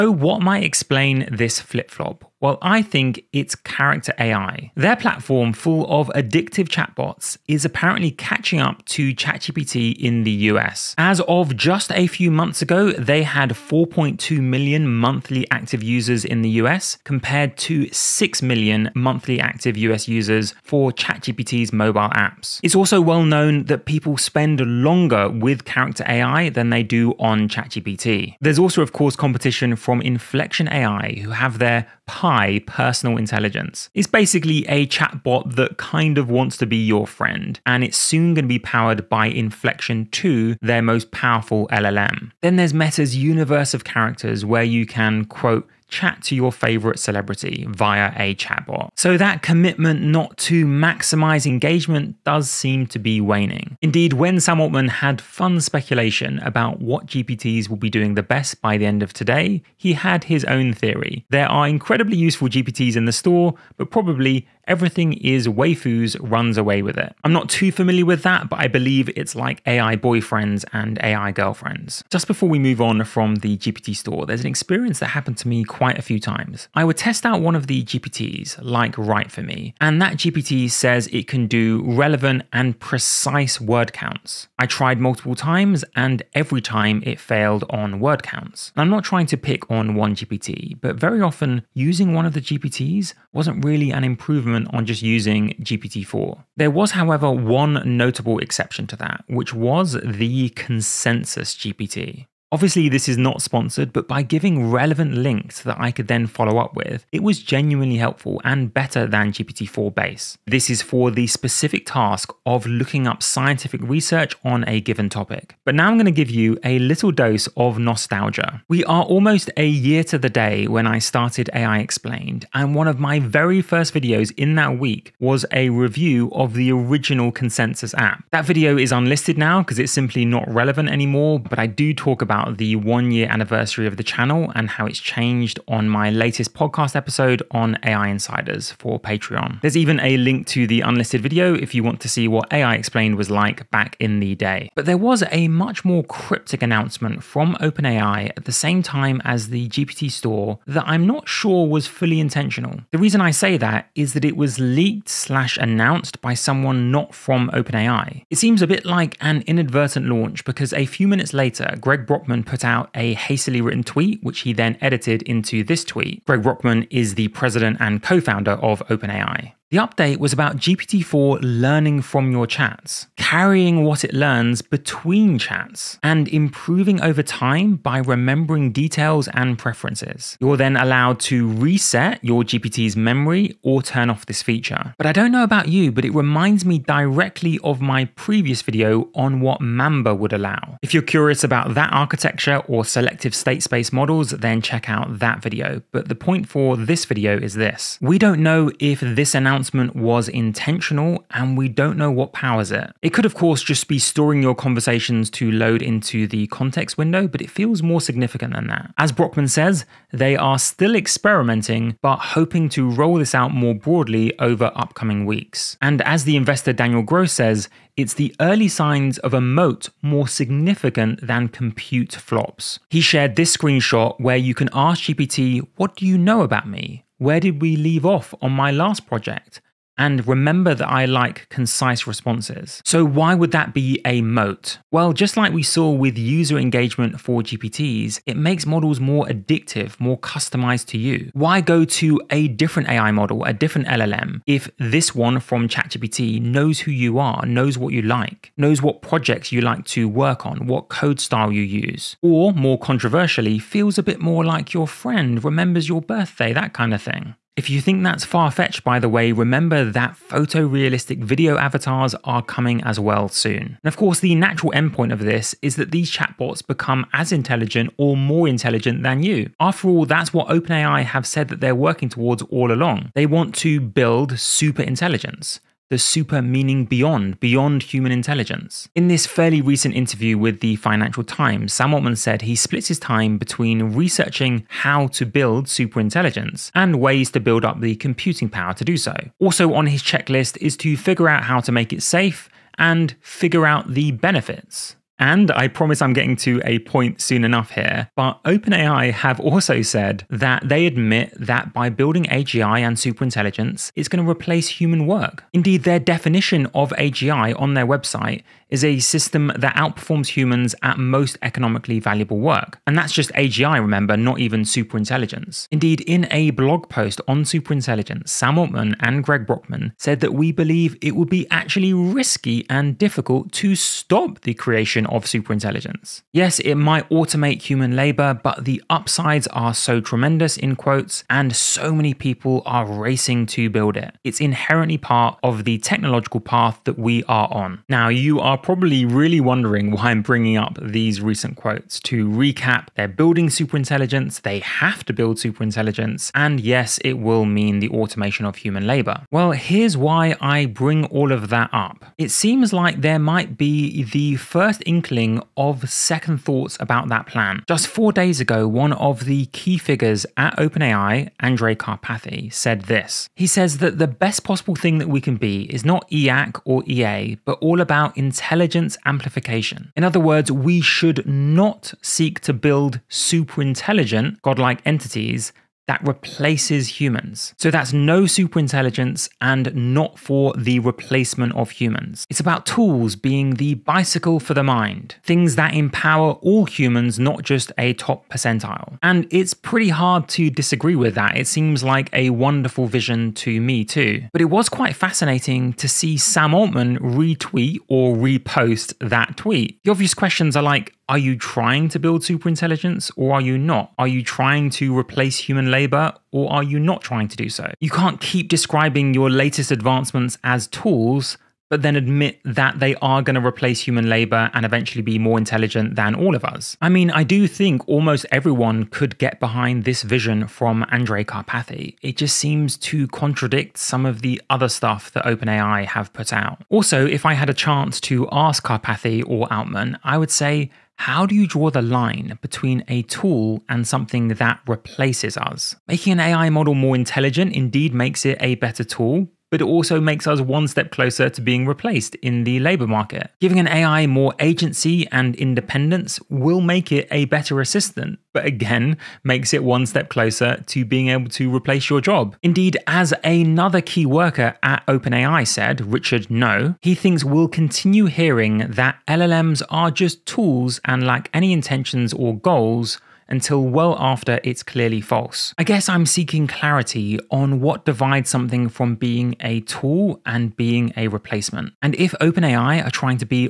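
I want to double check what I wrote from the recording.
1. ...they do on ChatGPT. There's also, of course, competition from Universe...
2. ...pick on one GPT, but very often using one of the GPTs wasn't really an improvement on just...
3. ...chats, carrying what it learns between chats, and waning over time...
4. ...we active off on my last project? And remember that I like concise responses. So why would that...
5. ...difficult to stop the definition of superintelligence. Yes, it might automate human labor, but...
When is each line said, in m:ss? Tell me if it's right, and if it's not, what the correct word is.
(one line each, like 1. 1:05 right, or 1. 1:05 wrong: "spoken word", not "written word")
1. 0:26 wrong: "Inflection", not "Universe"
2. 1:29 right
3. 2:52 wrong: "improving", not "waning"
4. 3:47 wrong: "leave", not "active"
5. 5:22 wrong: "creation", not "definition".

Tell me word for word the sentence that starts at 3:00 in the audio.
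You're then allowed to reset your GPT's memory or turn off this feature.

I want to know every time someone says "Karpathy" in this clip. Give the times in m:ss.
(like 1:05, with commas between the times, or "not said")
6:01, 7:01, 7:08.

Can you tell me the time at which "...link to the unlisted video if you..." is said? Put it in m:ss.
2:20.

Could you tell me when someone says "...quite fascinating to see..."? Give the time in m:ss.
6:34.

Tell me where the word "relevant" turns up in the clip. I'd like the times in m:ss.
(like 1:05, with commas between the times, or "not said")
1:21, 1:44, 2:10.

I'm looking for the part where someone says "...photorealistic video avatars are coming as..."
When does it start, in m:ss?
4:20.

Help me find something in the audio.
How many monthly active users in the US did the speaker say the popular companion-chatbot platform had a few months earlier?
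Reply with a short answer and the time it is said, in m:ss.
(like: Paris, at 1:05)
4.2 million, at 0:13.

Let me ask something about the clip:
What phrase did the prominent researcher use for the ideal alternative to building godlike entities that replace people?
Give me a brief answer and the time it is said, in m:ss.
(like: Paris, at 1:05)
intelligence amplification, at 6:08.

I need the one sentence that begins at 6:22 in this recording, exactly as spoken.
It's about tools being the bicycle for the mind, things that empower all humans, not just a top percentile.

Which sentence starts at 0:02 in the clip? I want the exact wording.
while I think it's character AI.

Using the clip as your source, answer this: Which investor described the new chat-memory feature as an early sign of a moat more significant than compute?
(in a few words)
Daniel Gross.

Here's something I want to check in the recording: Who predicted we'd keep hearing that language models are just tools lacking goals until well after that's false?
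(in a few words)
Richard Ngo.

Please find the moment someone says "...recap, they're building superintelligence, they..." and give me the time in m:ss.
5:42.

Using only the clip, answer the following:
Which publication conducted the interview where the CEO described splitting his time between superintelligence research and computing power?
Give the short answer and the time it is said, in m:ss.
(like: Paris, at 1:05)
Financial Times, at 4:40.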